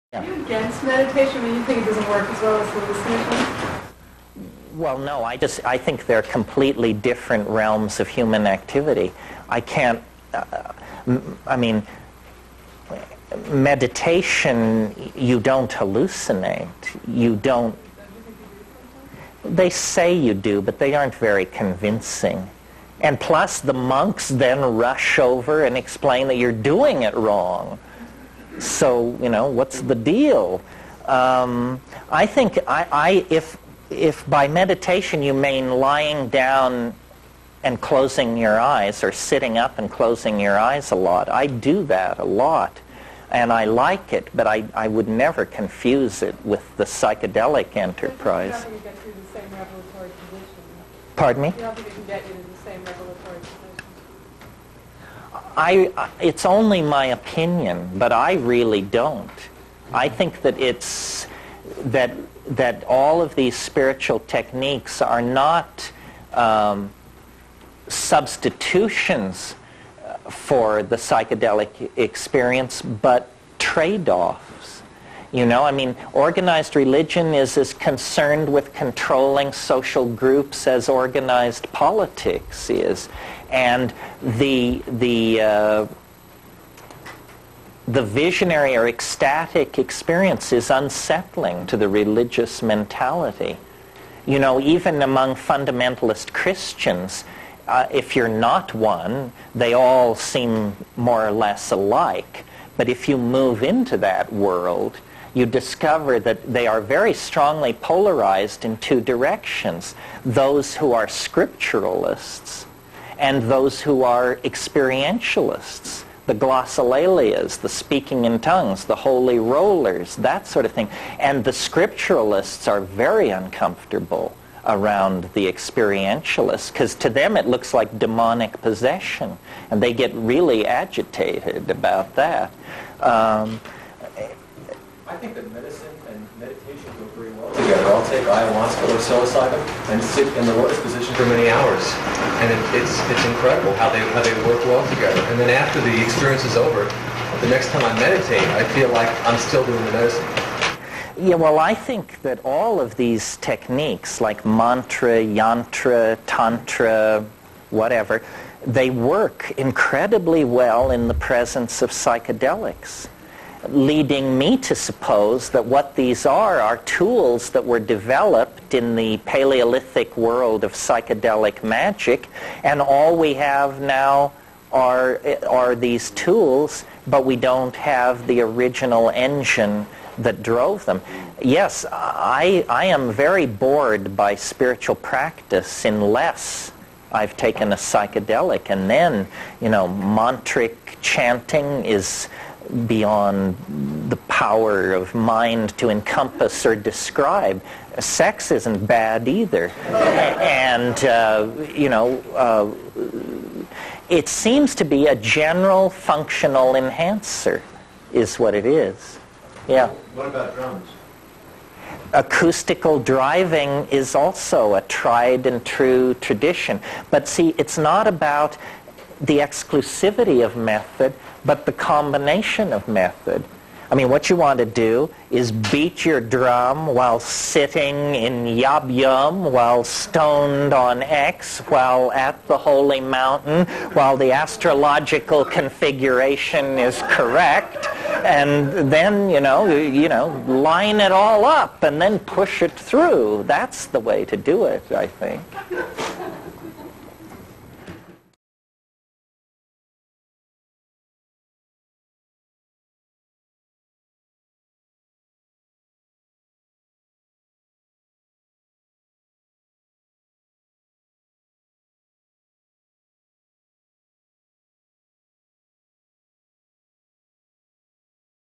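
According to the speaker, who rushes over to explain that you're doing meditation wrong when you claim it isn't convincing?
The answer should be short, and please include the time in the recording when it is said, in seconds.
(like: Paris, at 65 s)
The monks, at 23 s.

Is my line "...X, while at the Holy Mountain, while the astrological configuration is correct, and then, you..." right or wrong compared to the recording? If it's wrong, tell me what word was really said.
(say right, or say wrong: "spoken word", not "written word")
right.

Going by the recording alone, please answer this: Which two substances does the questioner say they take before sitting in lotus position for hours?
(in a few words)
Ayahuasca or psilocybin.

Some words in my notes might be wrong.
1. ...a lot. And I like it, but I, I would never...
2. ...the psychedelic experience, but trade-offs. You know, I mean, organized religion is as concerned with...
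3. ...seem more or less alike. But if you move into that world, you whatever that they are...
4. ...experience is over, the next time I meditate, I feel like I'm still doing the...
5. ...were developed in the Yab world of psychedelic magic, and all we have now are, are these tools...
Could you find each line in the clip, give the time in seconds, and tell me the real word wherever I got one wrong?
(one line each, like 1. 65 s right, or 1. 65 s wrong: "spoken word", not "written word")
1. 42 s right
2. 70 s right
3. 100 s wrong: "discover", not "whatever"
4. 146 s right
5. 167 s wrong: "Paleolithic", not "Yab".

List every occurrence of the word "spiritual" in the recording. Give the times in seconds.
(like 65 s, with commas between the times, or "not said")
63 s, 184 s.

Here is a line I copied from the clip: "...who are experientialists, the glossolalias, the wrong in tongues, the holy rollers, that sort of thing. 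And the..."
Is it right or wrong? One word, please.
wrong.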